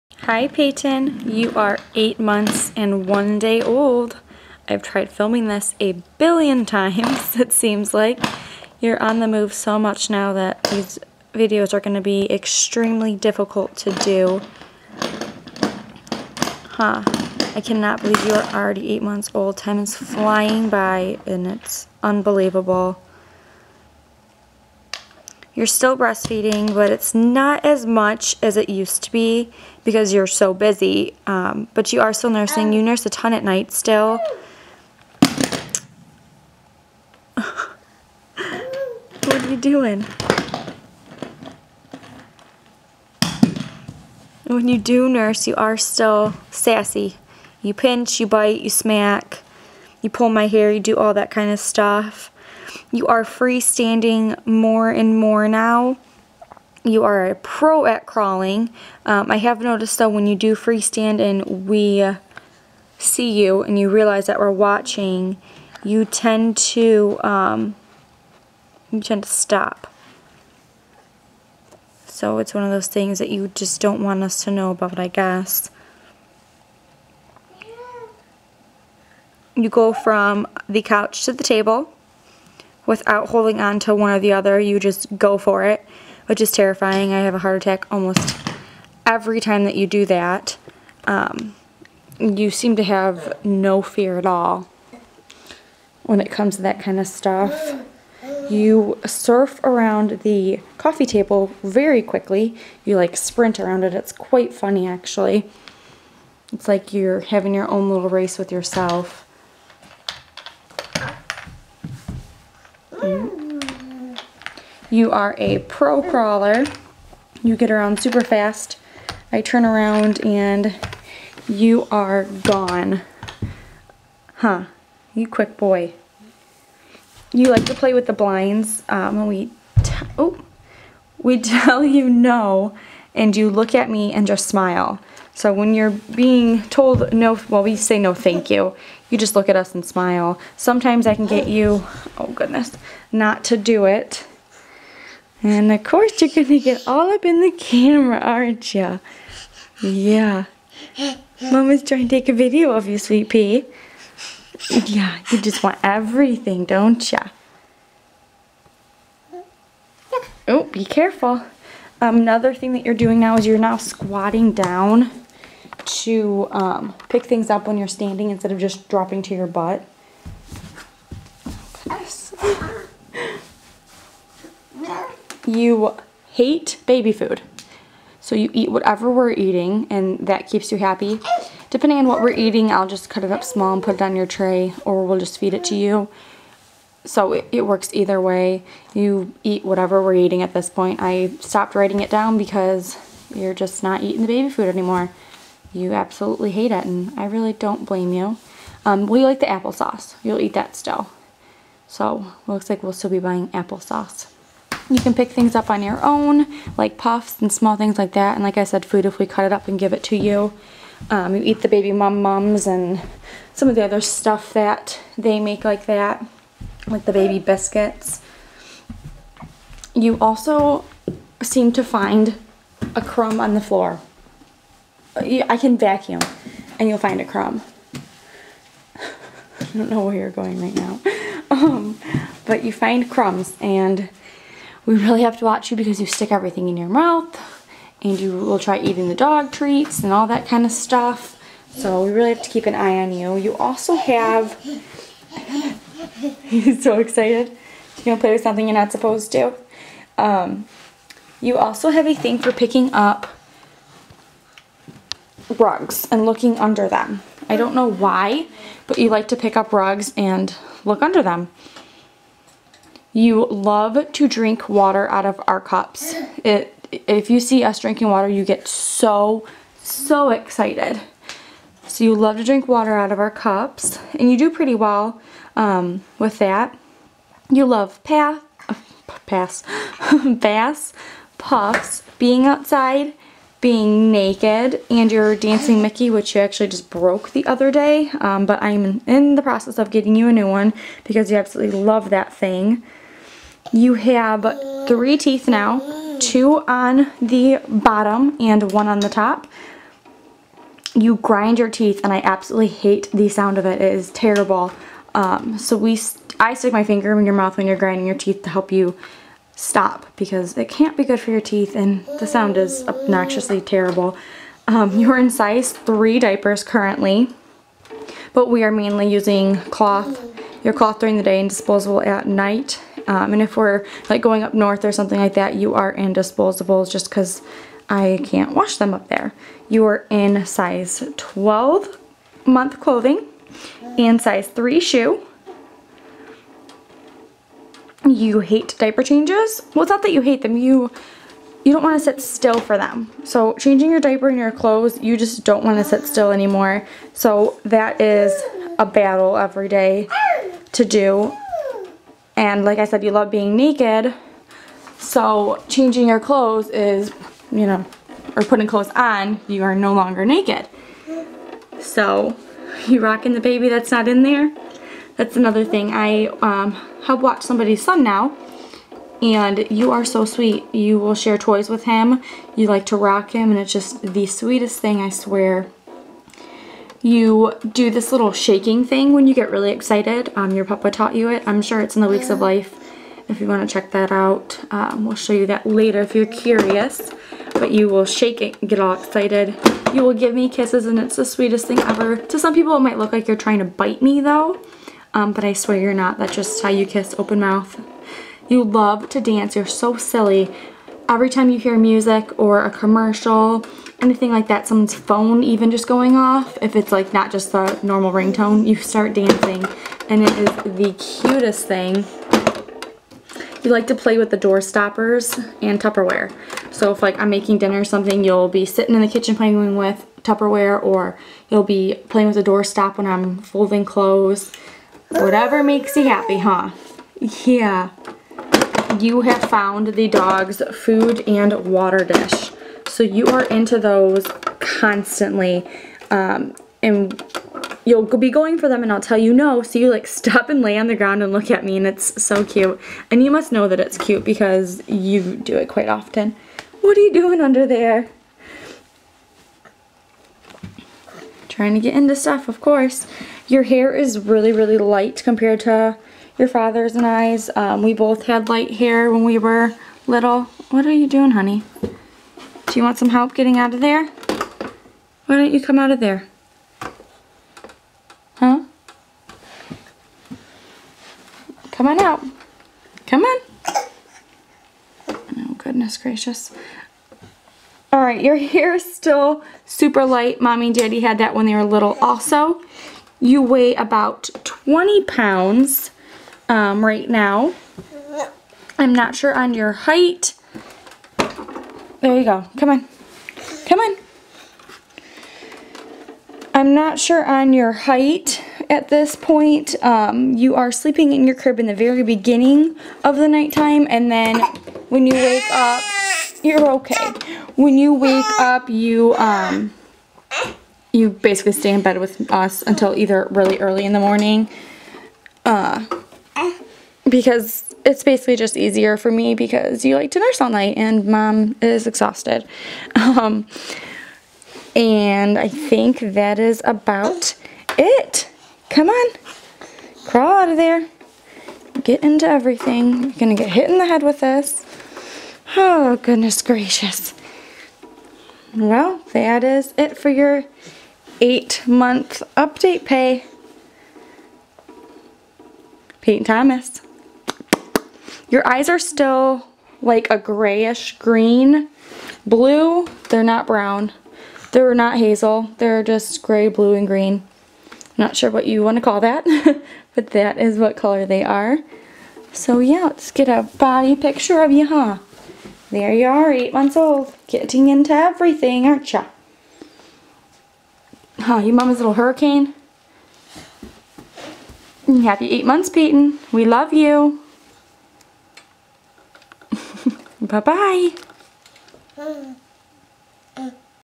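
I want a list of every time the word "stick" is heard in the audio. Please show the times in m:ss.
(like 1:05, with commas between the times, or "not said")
3:56, 5:06.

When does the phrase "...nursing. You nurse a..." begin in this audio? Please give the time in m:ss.
0:32.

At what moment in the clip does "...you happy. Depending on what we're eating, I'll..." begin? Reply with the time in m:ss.
3:00.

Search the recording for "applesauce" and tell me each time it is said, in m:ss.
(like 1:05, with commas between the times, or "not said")
3:19, 3:23.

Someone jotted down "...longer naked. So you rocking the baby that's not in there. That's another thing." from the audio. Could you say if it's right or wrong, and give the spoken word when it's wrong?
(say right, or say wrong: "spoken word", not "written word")
right.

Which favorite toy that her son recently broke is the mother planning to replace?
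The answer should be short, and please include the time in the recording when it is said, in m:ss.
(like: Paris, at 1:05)
dancing Mickey, at 4:45.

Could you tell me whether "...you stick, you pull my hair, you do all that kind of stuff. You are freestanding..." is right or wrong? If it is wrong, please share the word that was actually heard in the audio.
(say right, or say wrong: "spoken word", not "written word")
wrong: "smack", not "stick".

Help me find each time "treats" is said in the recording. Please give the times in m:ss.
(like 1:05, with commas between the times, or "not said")
3:59.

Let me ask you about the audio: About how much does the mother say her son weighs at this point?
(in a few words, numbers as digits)
20 pounds.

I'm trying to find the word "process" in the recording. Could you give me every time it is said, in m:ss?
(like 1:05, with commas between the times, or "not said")
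4:49.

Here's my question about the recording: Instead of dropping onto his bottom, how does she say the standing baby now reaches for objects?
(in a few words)
squatting.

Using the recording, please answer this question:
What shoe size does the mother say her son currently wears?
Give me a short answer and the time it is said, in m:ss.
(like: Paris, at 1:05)
size 3, at 5:34.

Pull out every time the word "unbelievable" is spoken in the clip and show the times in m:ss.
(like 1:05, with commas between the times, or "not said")
0:22.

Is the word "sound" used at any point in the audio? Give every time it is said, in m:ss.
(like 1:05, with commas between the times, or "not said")
5:03, 5:12.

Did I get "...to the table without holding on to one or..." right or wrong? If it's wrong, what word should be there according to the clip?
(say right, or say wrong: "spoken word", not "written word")
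right.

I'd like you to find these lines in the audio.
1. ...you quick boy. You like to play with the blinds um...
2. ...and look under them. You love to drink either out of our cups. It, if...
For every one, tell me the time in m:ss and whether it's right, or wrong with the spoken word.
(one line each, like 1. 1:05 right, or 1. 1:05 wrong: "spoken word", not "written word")
1. 2:05 right
2. 4:20 wrong: "water", not "either".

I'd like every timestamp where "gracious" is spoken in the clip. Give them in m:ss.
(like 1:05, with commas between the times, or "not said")
7:55, 8:56.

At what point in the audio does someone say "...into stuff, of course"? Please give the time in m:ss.
7:31.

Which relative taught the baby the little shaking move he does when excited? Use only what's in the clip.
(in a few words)
papa.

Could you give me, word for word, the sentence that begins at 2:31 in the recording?
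Mama's trying to take a video of you, sweet pea.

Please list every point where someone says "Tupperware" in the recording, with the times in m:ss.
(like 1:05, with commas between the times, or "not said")
6:55, 7:00.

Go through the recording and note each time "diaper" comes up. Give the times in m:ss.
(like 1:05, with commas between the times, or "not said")
5:16, 5:38, 5:43.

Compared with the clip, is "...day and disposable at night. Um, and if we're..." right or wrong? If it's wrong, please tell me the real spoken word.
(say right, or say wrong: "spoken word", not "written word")
right.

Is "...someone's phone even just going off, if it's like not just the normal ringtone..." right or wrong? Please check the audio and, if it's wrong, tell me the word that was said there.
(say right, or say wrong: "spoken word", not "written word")
right.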